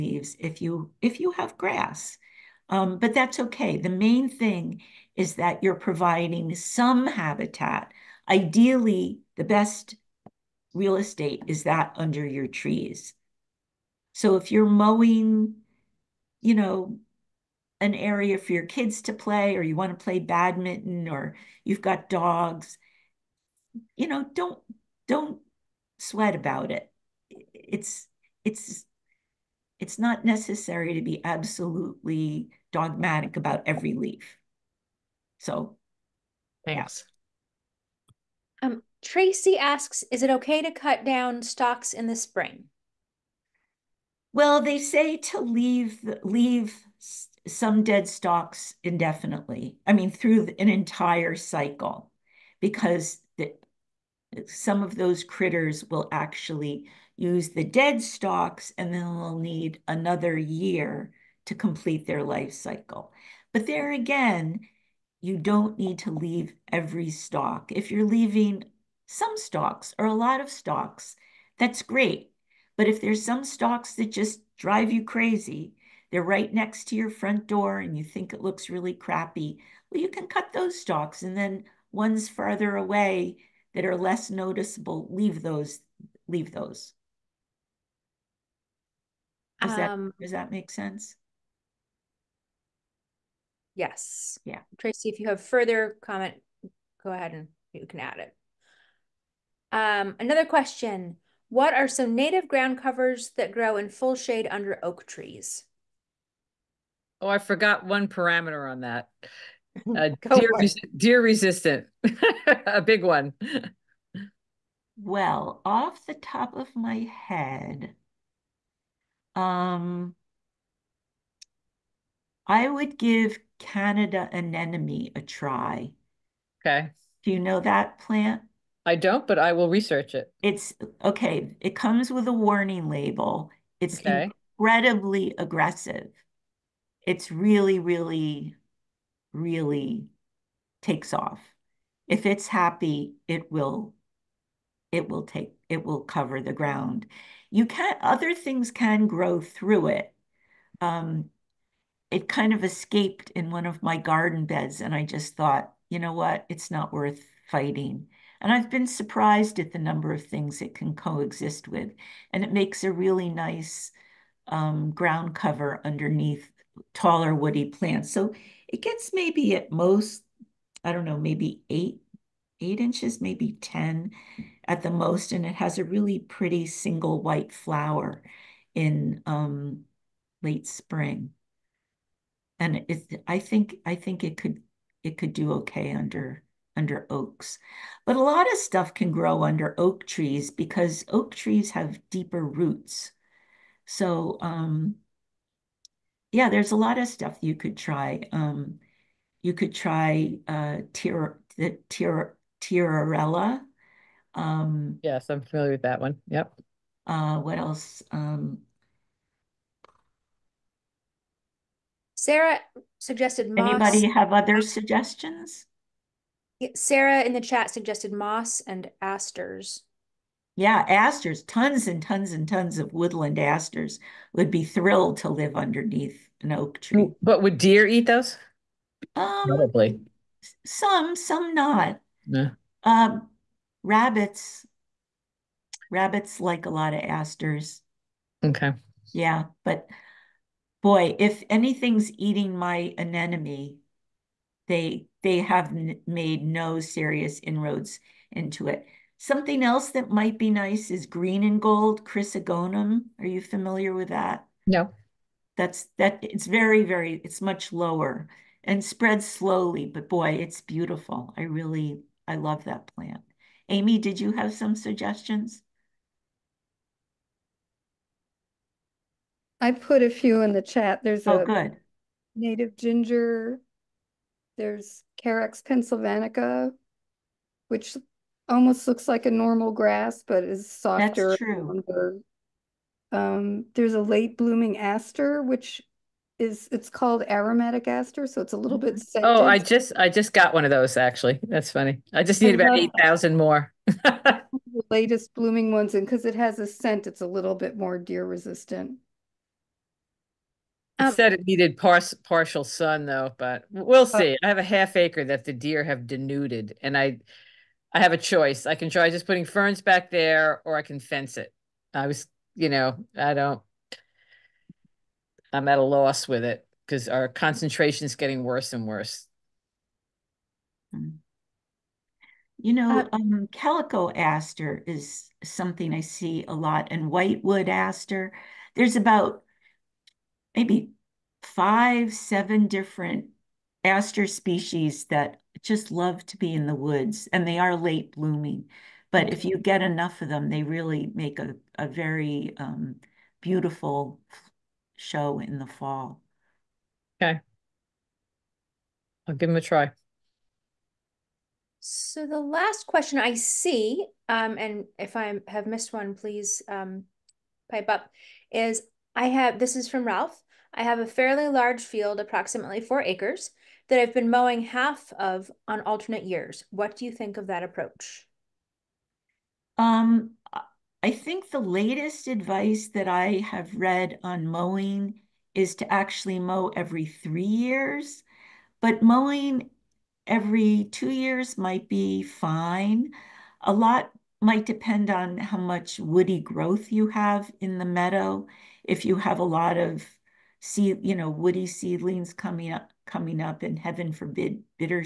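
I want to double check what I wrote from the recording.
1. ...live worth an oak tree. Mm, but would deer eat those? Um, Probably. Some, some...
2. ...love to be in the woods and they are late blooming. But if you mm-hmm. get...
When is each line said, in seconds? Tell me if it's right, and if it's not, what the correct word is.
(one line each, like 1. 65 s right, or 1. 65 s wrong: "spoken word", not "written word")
1. 225 s wrong: "underneath", not "worth"
2. 335 s right.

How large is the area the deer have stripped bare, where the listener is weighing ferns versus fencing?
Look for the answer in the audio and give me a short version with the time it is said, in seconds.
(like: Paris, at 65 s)
half acre, at 304 s.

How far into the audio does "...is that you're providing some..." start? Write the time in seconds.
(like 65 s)
5 s.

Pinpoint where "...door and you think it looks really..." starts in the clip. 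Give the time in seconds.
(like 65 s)
77 s.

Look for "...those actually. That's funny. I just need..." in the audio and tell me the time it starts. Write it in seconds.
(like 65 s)
290 s.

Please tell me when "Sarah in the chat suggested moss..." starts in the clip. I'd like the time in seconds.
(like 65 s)
216 s.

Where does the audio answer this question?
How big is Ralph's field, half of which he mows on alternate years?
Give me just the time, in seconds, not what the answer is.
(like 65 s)
362 s.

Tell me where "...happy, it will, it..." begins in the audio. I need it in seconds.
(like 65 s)
142 s.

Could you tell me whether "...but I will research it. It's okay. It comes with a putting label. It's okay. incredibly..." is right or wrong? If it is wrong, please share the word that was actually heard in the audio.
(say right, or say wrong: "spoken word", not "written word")
wrong: "warning", not "putting".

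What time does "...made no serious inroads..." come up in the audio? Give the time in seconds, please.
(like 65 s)
246 s.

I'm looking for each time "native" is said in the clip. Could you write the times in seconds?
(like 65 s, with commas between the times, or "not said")
102 s, 272 s.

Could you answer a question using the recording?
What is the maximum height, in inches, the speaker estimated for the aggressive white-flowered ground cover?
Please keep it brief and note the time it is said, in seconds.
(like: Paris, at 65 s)
10, at 173 s.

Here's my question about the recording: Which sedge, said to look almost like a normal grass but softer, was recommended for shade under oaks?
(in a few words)
Carex pennsylvanica.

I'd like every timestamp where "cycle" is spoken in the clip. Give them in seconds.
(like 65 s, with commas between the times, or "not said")
51 s, 62 s.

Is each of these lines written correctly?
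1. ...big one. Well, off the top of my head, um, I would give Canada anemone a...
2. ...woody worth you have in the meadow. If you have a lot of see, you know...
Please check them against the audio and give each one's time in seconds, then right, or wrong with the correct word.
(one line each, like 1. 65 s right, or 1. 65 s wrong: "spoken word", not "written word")
1. 112 s right
2. 385 s wrong: "growth", not "worth".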